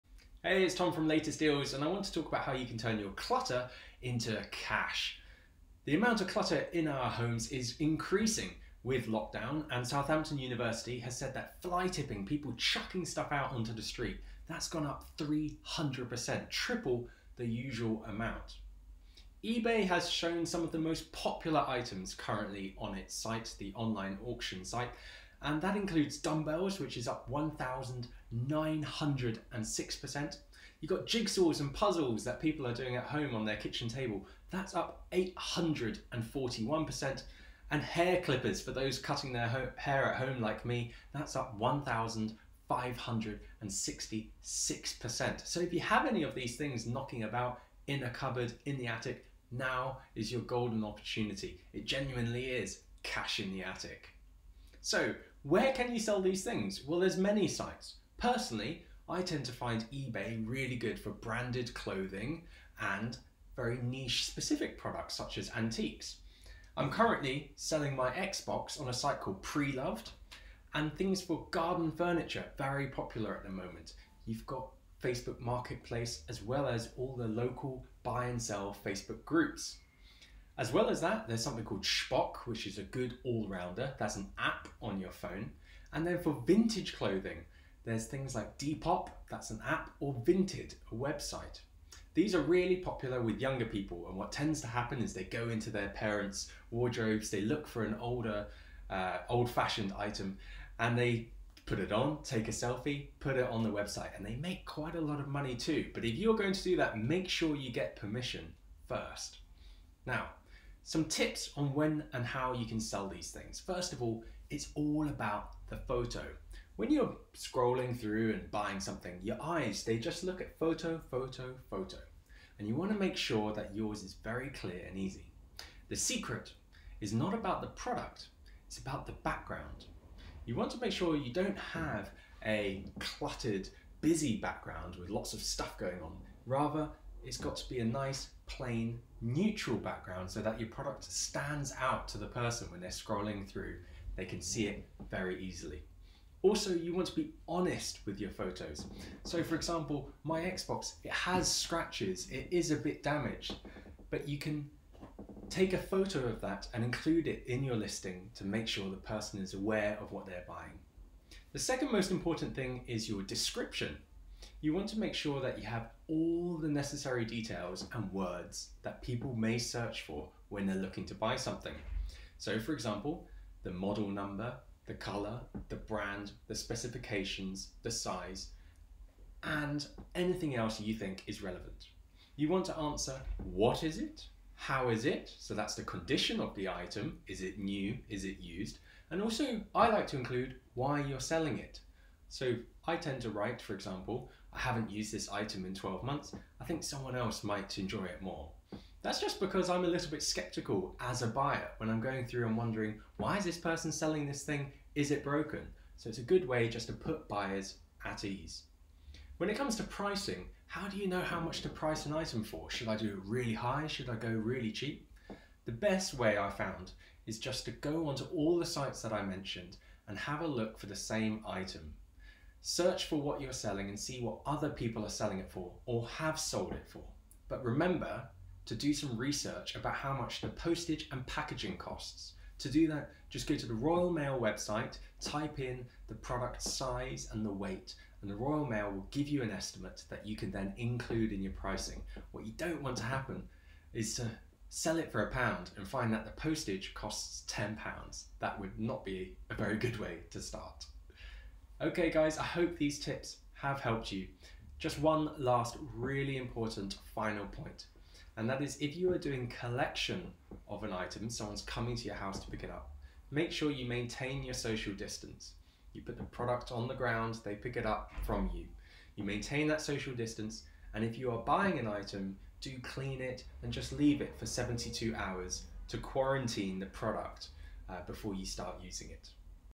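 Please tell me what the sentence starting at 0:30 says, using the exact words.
You've got jigsaws and puzzles that people are doing at home on their kitchen table, that's up 841%.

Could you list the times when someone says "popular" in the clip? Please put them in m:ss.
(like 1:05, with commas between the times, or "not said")
0:21, 1:12, 1:32.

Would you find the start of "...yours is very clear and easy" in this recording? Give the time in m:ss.
2:03.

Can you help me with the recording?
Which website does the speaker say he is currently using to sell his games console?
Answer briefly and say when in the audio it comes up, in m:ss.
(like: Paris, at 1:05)
Preloved, at 1:09.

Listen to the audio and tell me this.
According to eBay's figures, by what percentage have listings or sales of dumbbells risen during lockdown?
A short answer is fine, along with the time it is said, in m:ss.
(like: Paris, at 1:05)
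1,906%, at 0:27.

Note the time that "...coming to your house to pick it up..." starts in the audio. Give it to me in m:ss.
4:21.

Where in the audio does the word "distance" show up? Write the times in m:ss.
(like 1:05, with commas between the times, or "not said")
4:24, 4:30.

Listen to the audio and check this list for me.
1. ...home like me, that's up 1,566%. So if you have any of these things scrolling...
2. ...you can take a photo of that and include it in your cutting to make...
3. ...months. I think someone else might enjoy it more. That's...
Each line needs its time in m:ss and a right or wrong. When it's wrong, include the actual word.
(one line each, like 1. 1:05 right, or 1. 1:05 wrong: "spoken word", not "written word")
1. 0:40 wrong: "knocking", not "scrolling"
2. 2:34 wrong: "listing", not "cutting"
3. 3:16 right.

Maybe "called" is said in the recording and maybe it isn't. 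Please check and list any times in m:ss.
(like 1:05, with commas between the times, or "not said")
1:09, 1:21.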